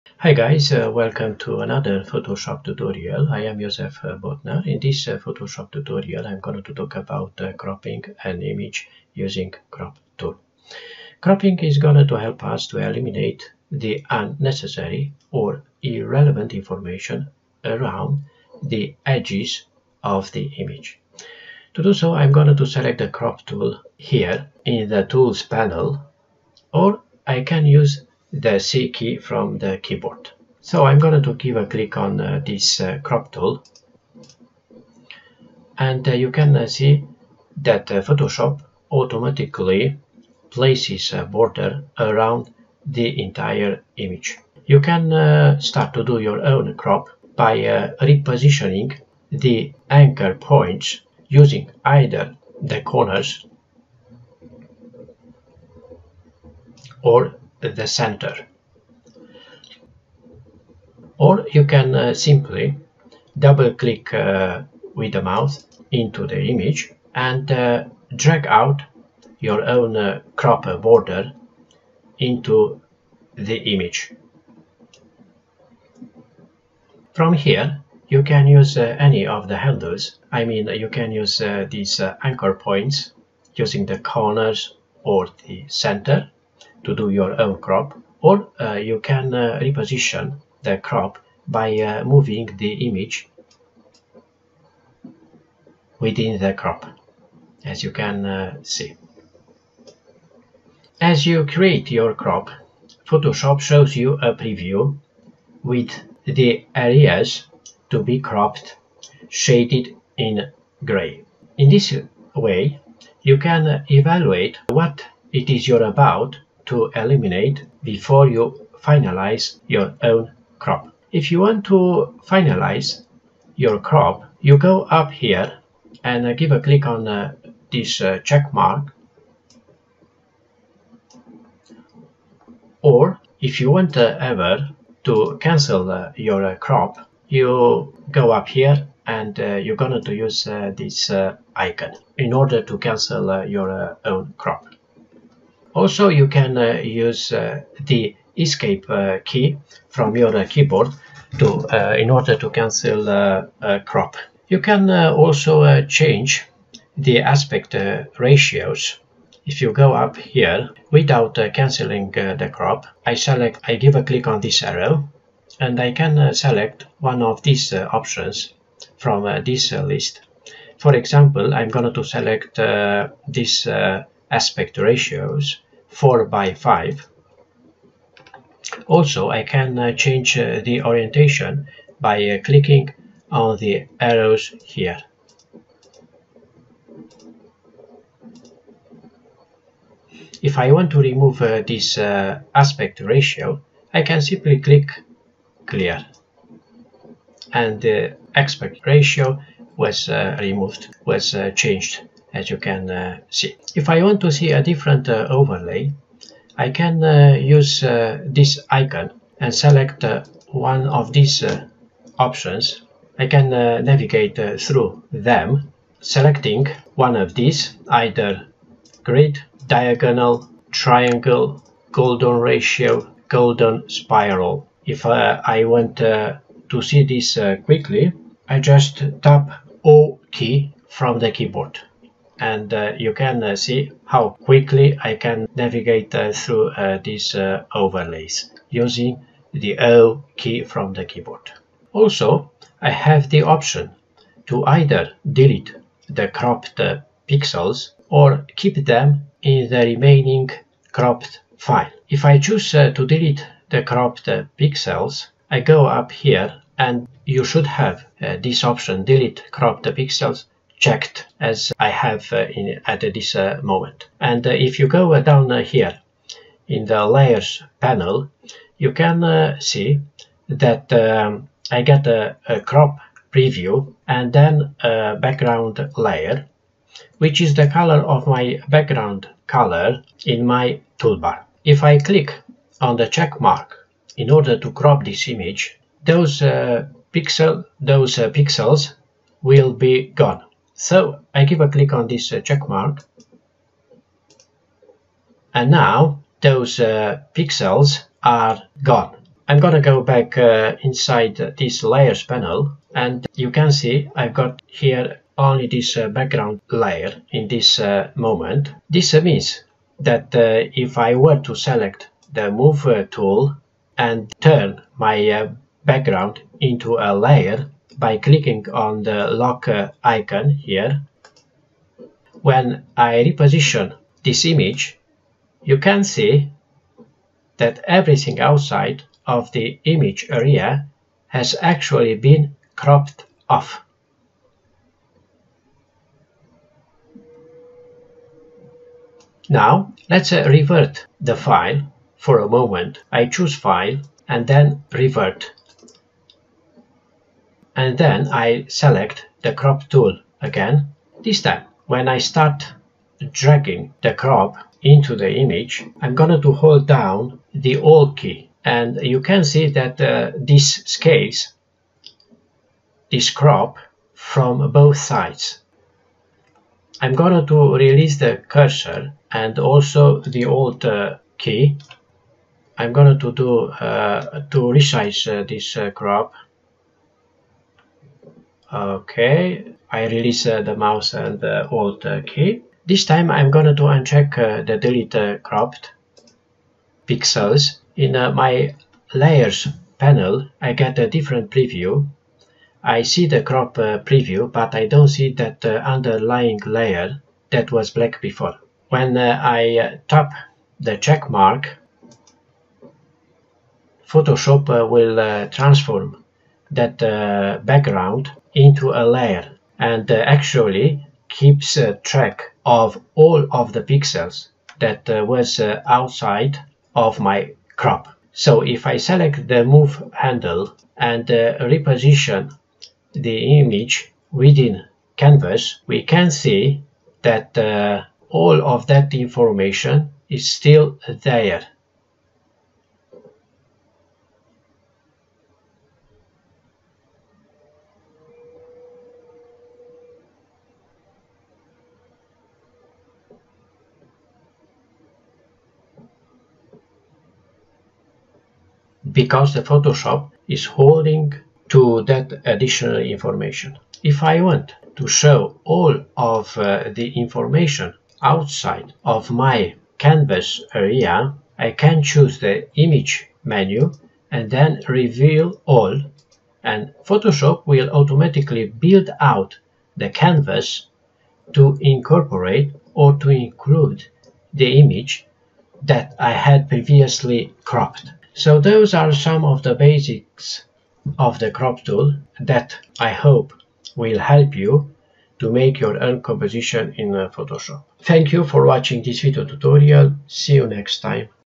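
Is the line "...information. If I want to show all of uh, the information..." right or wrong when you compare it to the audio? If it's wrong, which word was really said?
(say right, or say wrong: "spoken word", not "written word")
right.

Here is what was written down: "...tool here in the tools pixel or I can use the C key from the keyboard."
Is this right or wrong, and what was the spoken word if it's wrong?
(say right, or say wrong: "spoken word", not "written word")
wrong: "panel", not "pixel".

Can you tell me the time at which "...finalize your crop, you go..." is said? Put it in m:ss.
2:02.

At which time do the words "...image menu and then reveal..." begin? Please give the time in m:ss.
7:42.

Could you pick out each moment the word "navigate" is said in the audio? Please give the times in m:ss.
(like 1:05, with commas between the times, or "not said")
3:33, 3:55.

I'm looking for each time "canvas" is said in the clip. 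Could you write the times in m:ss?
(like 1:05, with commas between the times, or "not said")
7:05, 7:39, 7:50.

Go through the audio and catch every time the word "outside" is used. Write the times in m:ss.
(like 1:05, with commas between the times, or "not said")
5:28, 6:55, 7:38.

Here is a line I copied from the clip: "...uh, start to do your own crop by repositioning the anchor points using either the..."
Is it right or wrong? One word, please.
right.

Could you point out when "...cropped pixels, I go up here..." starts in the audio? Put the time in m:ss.
4:13.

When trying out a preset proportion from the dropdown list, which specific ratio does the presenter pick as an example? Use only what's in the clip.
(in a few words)
4 by 5.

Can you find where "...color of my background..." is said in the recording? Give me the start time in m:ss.
4:37.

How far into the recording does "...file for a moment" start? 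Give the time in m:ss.
5:41.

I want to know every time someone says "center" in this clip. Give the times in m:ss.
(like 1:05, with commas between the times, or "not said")
0:57, 1:25.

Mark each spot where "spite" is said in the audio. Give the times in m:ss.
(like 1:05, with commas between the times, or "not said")
not said.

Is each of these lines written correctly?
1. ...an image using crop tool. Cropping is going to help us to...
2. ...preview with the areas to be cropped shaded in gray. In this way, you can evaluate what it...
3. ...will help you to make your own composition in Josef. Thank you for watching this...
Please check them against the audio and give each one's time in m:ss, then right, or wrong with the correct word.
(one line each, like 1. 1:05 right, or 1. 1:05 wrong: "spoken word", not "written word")
1. 0:08 right
2. 1:44 right
3. 8:03 wrong: "Photoshop", not "Josef".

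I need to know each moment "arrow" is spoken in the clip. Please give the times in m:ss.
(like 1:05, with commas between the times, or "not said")
2:44, 3:03.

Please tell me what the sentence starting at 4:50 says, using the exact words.
So I give a click on this uh, check mark and now those uh, pixels are gone.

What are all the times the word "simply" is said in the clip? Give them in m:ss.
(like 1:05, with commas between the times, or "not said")
1:02, 3:14.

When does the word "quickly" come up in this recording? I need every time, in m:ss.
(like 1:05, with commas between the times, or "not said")
3:47, 3:54.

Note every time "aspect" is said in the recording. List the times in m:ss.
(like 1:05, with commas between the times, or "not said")
2:37, 2:54, 3:11, 3:18.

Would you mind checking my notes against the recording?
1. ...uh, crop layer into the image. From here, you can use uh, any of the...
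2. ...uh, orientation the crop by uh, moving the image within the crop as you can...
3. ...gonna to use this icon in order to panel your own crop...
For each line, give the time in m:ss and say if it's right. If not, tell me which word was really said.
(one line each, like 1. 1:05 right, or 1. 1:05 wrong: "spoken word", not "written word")
1. 1:09 wrong: "border", not "layer"
2. 1:29 wrong: "reposition", not "orientation"
3. 2:19 wrong: "cancel", not "panel".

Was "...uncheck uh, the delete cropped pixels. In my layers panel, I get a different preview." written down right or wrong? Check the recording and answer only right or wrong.
right.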